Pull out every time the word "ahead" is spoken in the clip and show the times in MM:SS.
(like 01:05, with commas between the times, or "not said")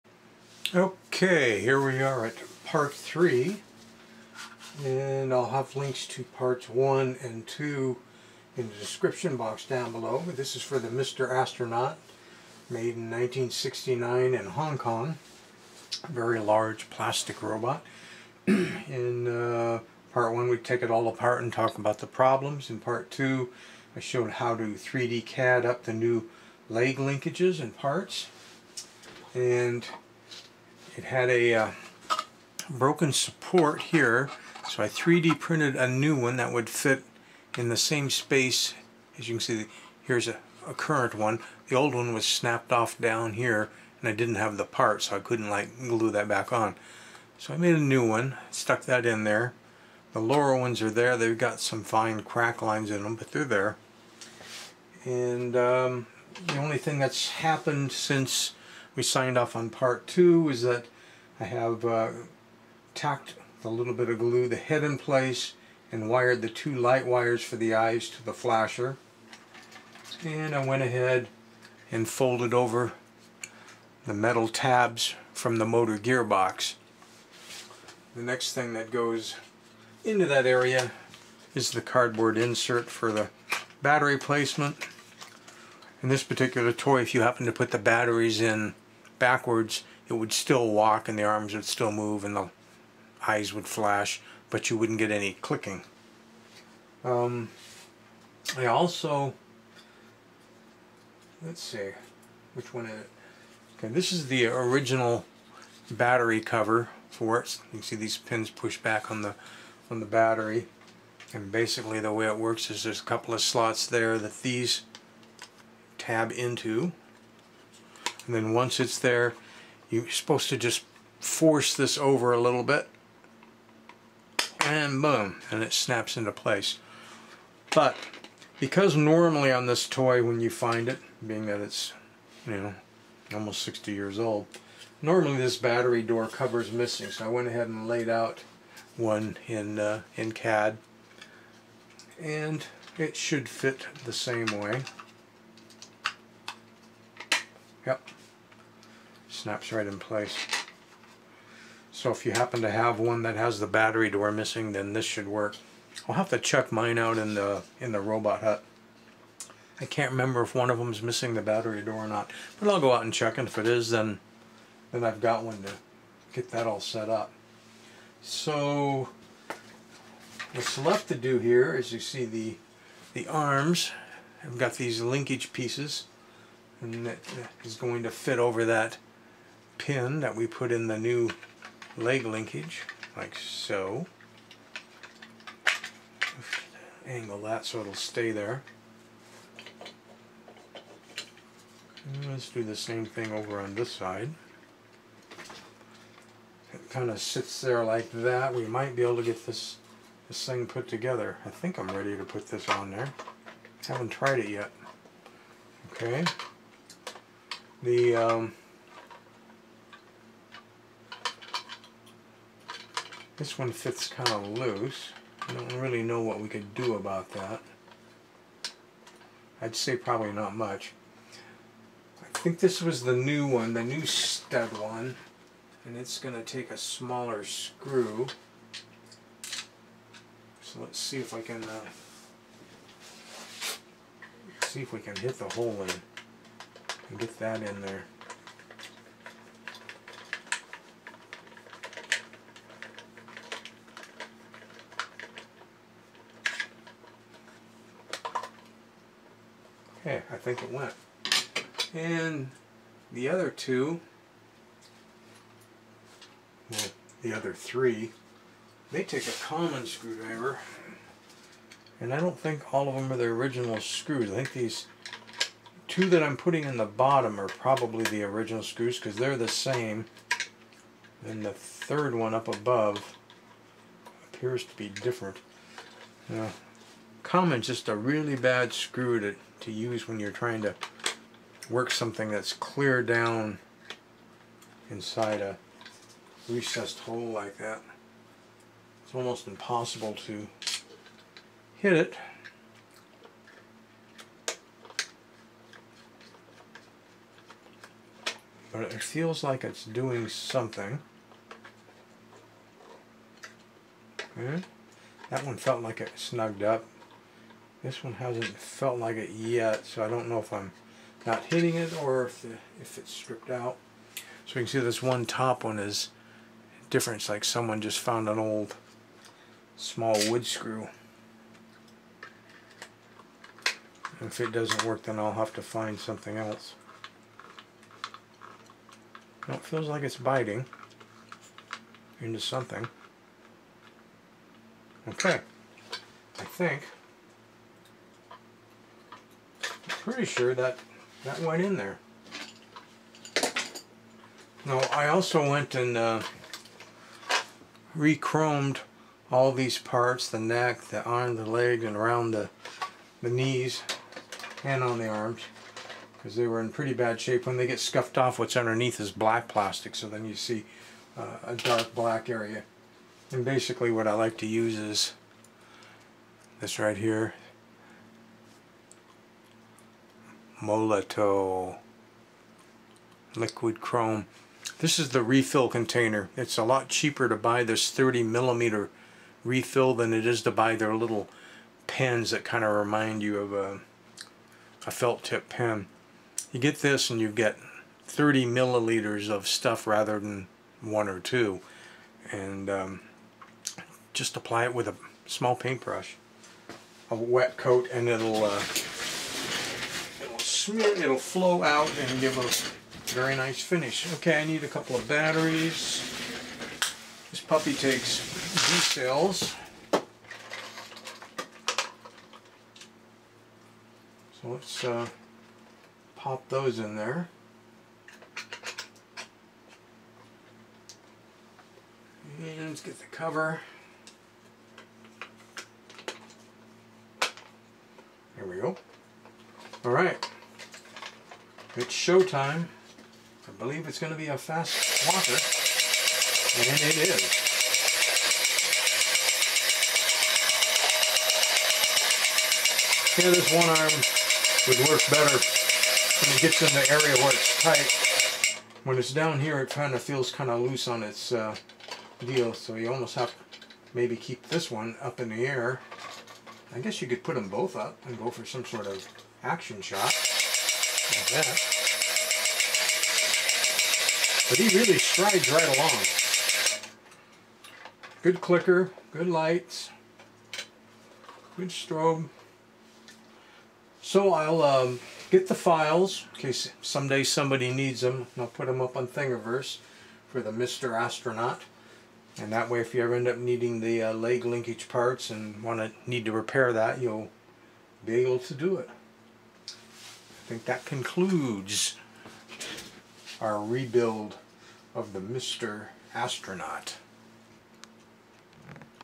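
01:10, 02:17.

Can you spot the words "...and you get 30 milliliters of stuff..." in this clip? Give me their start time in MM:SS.
06:27.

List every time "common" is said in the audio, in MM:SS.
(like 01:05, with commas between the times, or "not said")
04:19, 04:37.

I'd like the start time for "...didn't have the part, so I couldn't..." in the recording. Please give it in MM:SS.
00:44.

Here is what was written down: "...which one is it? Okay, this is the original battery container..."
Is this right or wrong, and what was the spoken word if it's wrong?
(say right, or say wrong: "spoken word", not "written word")
wrong: "cover", not "container".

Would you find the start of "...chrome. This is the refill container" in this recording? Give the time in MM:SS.
06:13.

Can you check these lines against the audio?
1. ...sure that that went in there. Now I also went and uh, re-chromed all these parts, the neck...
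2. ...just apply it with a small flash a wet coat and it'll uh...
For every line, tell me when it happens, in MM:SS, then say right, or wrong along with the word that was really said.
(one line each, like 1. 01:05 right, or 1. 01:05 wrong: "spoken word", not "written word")
1. 05:40 right
2. 06:34 wrong: "paintbrush", not "flash".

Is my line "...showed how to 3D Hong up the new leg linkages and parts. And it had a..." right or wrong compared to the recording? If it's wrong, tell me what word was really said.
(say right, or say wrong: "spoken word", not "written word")
wrong: "CAD", not "Hong".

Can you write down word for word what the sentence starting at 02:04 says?
And boom, and it snaps into place.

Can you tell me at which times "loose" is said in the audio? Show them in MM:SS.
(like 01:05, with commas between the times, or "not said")
03:34, 07:30.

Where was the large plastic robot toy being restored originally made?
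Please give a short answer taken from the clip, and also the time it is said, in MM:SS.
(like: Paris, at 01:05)
Hong Kong, at 00:14.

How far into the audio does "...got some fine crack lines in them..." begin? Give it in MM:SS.
00:51.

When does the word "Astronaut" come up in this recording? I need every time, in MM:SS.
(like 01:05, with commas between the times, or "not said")
00:11, 08:00, 08:16.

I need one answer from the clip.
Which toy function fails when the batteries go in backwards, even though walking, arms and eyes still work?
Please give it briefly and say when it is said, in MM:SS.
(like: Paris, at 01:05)
Clicking, at 01:35.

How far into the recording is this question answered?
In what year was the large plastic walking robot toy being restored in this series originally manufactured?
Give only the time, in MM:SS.
00:13.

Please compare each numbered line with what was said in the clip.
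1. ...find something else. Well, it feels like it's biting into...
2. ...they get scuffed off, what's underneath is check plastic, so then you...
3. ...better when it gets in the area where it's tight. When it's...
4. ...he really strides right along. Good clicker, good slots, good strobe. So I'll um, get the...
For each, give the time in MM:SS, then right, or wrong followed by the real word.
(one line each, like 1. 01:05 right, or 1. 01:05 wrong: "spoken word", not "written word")
1. 05:25 right
2. 05:57 wrong: "black", not "check"
3. 07:25 right
4. 07:44 wrong: "lights", not "slots".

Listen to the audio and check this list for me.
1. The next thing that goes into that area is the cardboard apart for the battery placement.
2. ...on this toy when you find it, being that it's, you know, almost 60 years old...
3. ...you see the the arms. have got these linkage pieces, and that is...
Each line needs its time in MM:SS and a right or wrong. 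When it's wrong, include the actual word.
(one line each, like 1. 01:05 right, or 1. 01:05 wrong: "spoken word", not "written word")
1. 01:18 wrong: "insert", not "apart"
2. 02:09 right
3. 02:51 right.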